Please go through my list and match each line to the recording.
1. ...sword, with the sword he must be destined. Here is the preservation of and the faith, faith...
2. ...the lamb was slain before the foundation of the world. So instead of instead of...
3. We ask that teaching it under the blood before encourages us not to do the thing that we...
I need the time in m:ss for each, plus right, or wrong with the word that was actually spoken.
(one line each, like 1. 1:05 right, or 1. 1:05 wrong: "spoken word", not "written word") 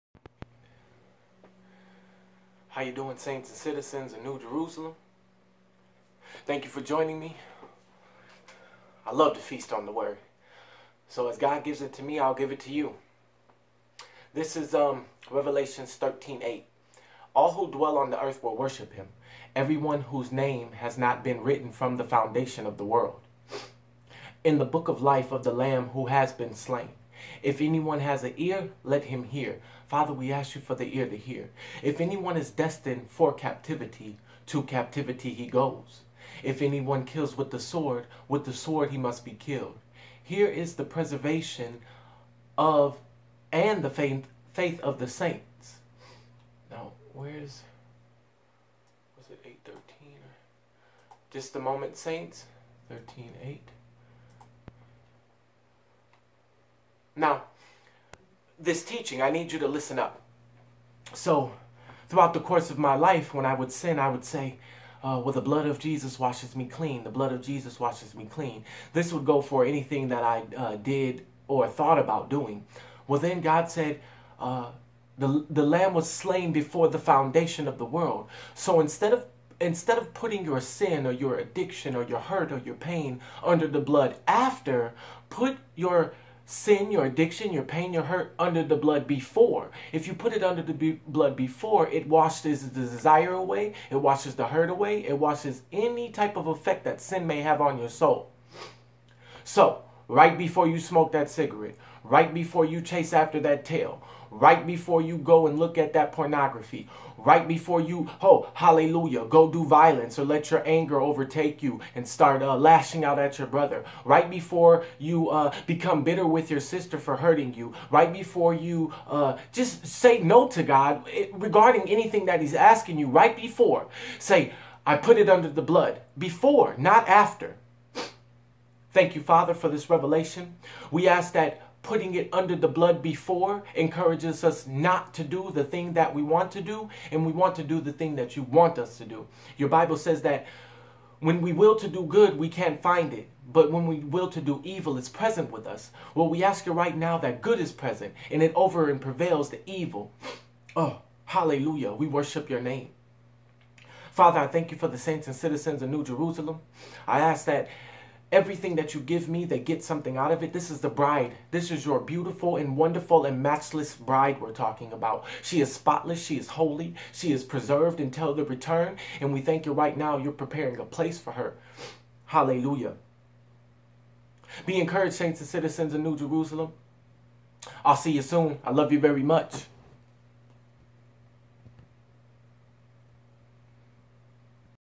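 1. 0:37 wrong: "killed", not "destined"
2. 1:15 right
3. 2:10 wrong: "putting", not "teaching".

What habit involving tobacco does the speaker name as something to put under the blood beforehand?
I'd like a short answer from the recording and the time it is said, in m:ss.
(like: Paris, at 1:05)
smoke that cigarette, at 1:40.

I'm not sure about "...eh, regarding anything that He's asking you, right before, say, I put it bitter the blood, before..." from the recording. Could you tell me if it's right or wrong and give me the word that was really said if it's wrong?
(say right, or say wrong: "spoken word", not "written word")
wrong: "under", not "bitter".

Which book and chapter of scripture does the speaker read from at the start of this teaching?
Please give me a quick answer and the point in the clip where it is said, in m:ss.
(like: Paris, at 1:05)
Revelation 13, at 0:15.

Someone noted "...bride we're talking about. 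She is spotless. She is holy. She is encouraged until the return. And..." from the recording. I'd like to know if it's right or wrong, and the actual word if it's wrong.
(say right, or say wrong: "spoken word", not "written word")
wrong: "preserved", not "encouraged".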